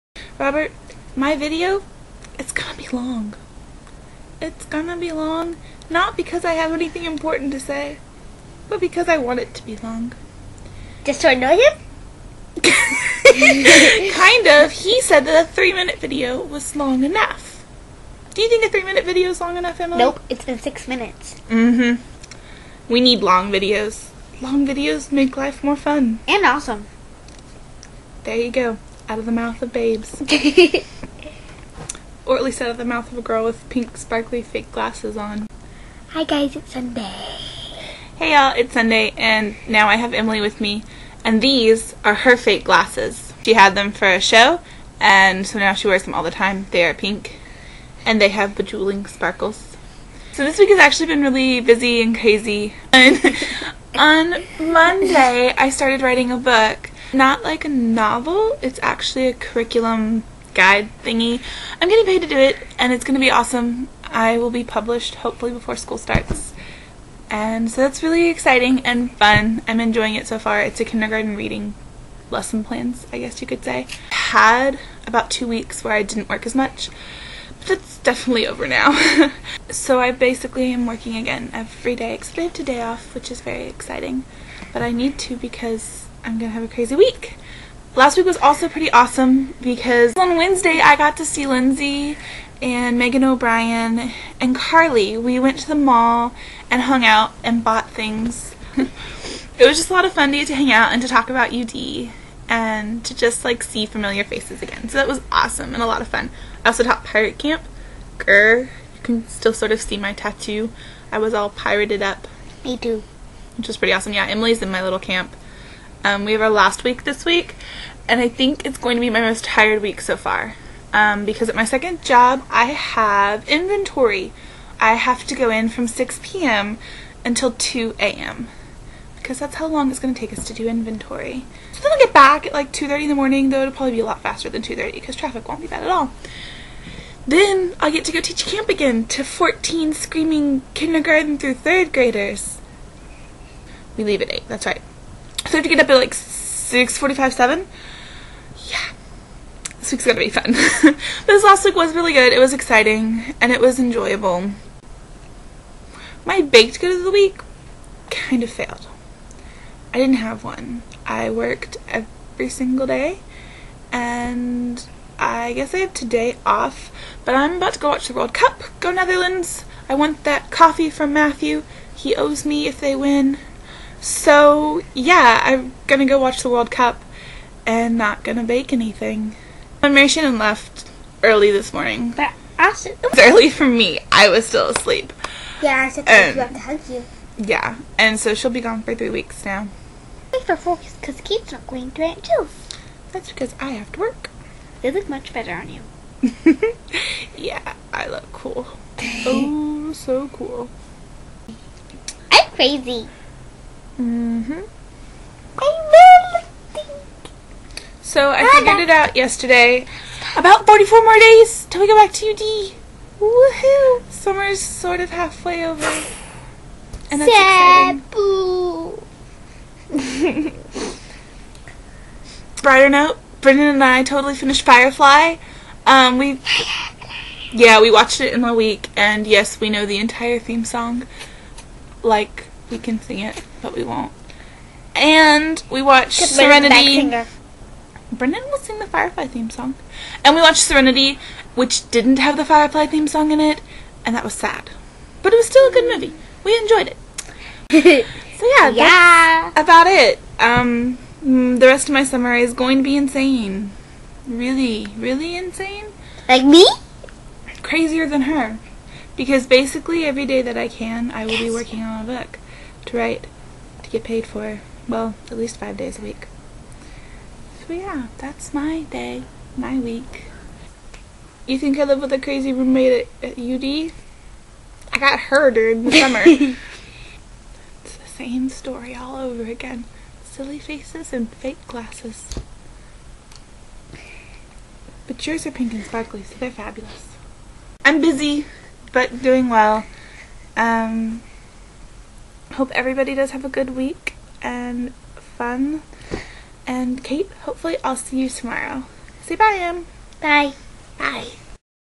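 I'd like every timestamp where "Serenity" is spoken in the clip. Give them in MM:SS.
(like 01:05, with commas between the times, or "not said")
03:56, 04:00.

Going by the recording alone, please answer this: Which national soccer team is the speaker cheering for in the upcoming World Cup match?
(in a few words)
Netherlands.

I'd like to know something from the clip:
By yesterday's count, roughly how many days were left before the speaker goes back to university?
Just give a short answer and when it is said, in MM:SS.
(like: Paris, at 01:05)
44, at 03:30.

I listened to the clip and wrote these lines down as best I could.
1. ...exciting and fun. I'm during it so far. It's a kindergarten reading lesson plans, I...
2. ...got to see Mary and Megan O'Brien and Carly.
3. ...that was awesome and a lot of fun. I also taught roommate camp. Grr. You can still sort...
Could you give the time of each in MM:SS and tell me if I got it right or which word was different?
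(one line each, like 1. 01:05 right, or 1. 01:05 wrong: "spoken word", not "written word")
1. 01:08 wrong: "enjoying", not "during"
2. 01:30 wrong: "Lindsay", not "Mary"
3. 01:44 wrong: "pirate", not "roommate".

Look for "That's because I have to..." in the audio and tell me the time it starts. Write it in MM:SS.
03:13.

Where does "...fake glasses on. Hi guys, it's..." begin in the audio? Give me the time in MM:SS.
00:34.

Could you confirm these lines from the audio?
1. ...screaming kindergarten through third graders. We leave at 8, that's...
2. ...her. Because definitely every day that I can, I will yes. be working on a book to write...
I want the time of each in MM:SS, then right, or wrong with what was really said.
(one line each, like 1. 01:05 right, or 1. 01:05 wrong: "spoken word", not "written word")
1. 02:19 right
2. 04:18 wrong: "basically", not "definitely".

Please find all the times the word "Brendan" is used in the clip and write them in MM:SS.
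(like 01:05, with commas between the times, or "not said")
03:43, 03:58.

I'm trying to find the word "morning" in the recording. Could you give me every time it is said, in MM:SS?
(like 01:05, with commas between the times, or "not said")
02:13, 03:01.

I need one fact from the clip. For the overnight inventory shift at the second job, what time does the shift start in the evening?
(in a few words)
6 p.m.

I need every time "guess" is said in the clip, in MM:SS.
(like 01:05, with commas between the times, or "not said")
01:13, 02:45.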